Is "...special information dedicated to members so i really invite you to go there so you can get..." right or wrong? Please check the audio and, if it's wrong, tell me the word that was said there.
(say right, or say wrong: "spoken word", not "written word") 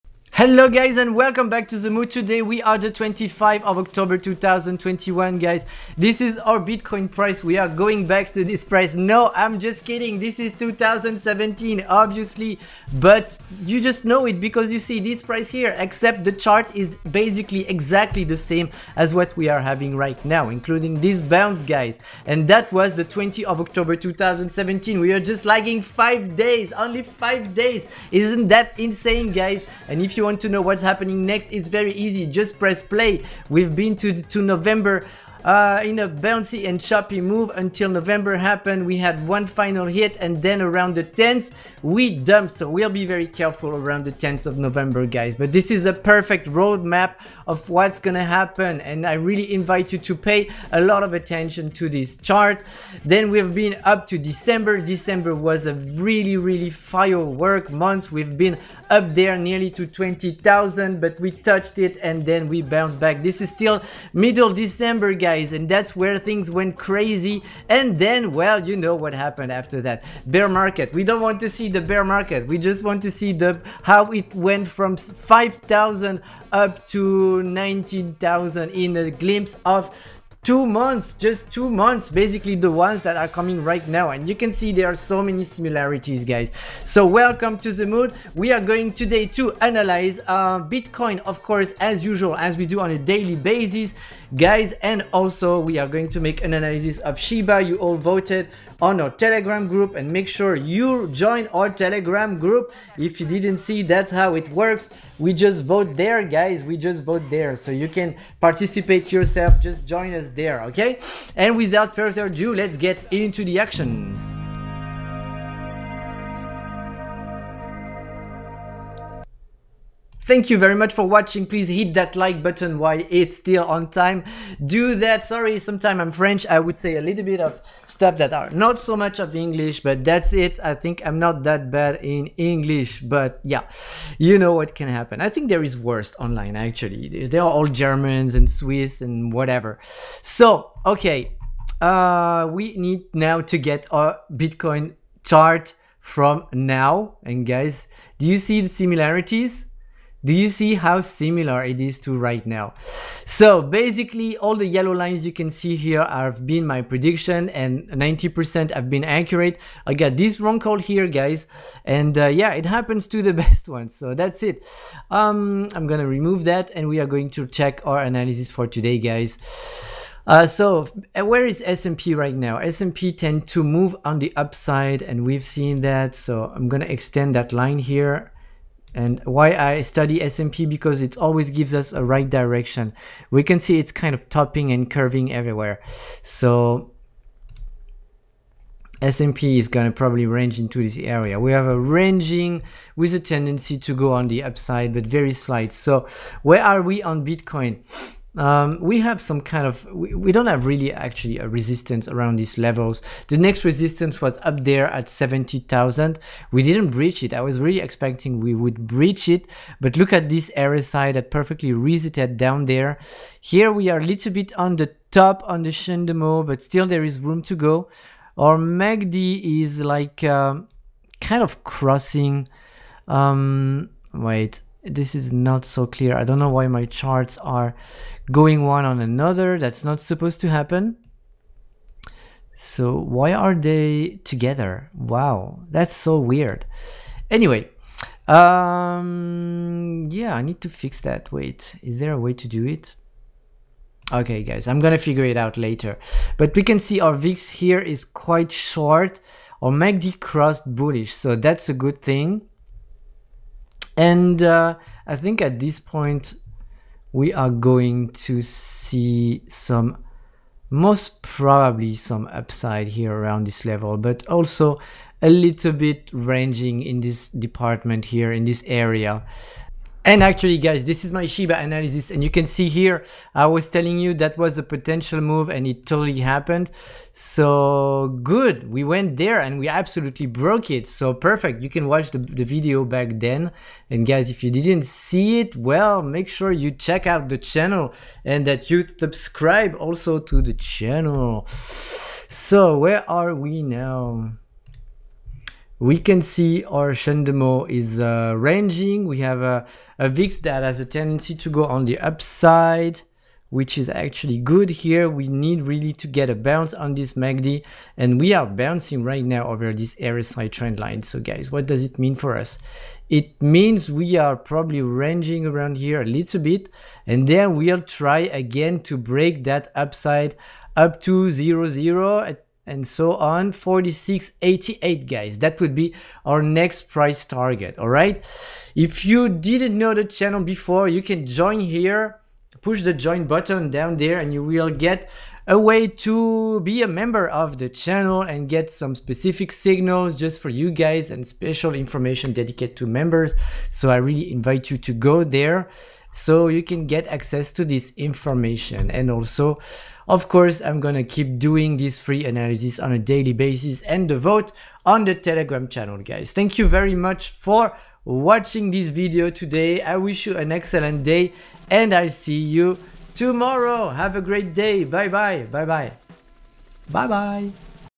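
right.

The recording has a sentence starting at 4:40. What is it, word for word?
So perfect, you can watch the, the video back then.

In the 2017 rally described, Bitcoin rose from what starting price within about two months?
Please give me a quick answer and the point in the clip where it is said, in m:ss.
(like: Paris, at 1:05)
5000, at 1:14.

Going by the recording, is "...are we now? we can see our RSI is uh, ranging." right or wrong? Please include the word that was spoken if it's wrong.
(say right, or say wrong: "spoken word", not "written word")
wrong: "Shendemo", not "RSI".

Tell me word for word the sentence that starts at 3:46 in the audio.
I don't know why my charts are going one on another.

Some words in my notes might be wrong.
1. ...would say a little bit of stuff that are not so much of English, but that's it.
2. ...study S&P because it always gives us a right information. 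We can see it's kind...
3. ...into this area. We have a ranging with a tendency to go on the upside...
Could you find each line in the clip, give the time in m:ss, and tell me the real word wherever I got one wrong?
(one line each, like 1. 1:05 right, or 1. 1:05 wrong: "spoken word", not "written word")
1. 2:06 right
2. 2:59 wrong: "direction", not "information"
3. 3:10 right.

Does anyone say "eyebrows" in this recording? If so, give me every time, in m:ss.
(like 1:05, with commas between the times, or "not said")
not said.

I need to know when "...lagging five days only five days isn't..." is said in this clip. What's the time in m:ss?
0:25.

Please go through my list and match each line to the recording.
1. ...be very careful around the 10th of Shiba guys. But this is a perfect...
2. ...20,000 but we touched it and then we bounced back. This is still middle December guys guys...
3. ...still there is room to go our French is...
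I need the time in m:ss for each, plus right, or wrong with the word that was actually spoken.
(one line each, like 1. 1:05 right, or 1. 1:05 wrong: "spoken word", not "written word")
1. 0:42 wrong: "November", not "Shiba"
2. 0:59 right
3. 3:36 wrong: "MACD", not "French".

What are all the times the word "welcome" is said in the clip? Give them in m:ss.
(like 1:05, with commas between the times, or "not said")
0:01, 1:27.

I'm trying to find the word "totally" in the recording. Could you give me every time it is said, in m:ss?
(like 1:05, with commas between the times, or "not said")
4:35.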